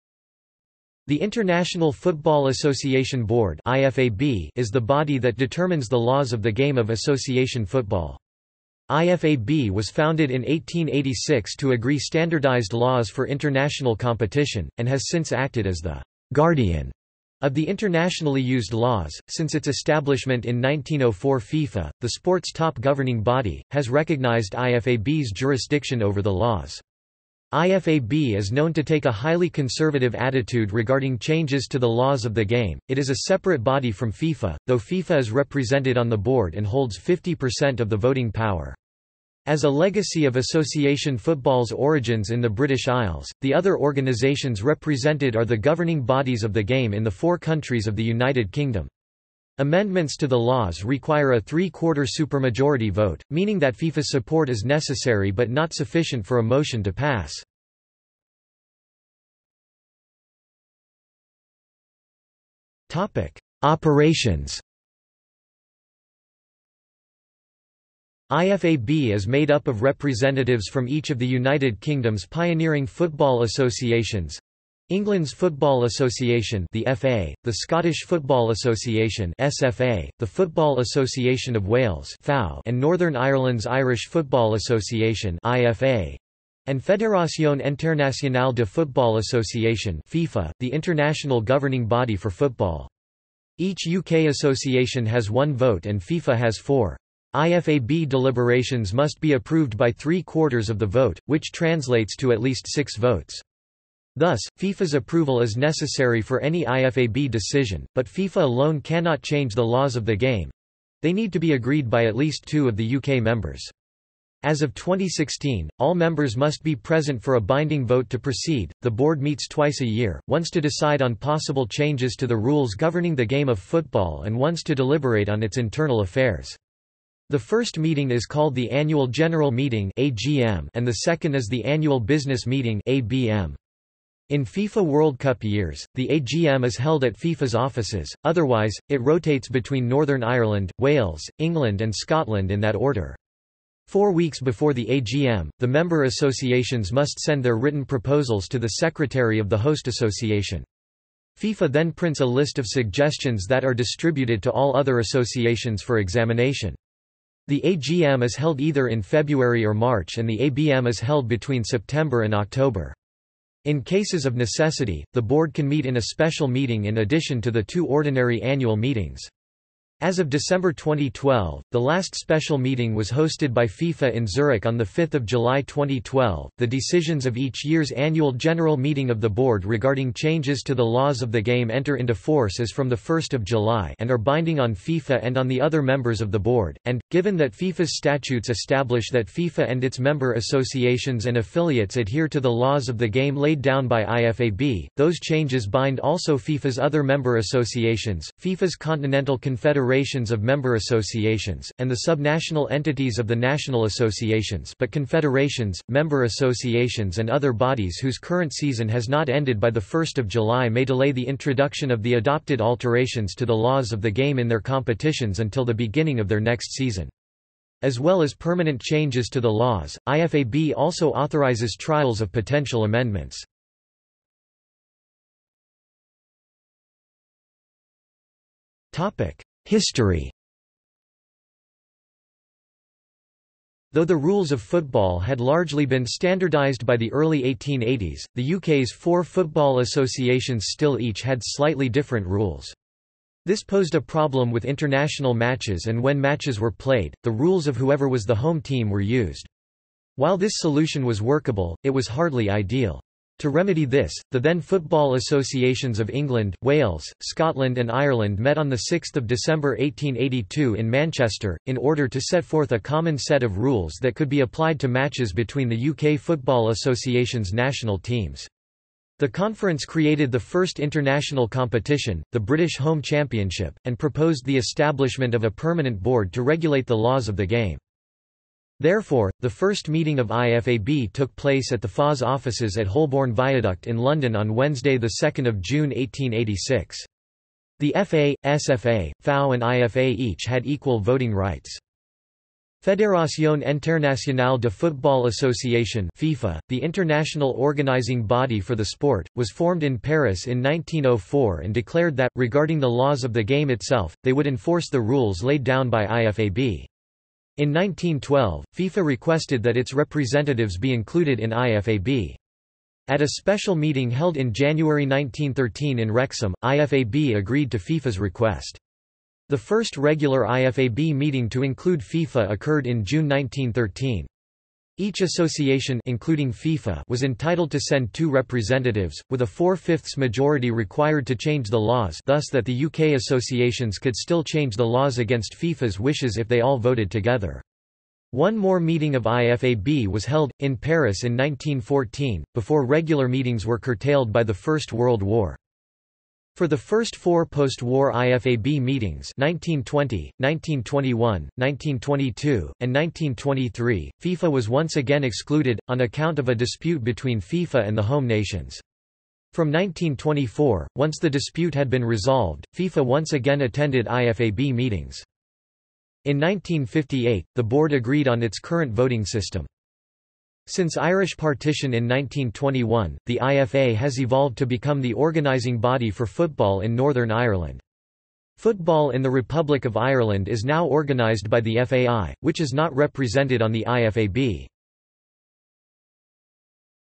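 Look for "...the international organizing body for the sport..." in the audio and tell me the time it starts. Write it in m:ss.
4:56.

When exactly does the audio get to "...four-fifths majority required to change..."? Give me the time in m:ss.
5:29.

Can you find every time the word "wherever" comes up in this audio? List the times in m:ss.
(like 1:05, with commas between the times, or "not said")
not said.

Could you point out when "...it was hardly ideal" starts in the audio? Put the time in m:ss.
4:11.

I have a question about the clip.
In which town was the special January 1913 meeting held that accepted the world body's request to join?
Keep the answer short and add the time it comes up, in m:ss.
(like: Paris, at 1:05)
Wrexham, at 5:16.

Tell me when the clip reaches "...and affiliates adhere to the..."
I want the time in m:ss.
3:11.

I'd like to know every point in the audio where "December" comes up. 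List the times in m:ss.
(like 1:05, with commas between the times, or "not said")
2:50, 4:19.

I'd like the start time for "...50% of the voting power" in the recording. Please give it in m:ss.
0:36.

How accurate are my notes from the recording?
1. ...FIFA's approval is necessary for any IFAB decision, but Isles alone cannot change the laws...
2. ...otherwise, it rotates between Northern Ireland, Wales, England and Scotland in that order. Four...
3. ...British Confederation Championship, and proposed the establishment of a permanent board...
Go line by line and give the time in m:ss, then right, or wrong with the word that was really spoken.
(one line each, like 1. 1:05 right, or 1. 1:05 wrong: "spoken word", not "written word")
1. 1:44 wrong: "FIFA", not "Isles"
2. 2:18 right
3. 4:32 wrong: "Home", not "Confederation".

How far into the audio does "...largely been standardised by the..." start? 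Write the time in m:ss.
3:55.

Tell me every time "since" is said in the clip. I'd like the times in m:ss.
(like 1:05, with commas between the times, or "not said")
0:15, 0:19, 6:10.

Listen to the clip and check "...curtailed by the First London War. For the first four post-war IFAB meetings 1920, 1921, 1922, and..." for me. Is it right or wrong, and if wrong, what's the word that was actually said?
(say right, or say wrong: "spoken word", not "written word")
wrong: "World", not "London".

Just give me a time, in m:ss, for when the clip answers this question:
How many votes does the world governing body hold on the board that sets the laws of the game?
1:36.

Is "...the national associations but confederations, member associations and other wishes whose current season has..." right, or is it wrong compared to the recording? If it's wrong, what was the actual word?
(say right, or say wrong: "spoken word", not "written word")
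wrong: "bodies", not "wishes".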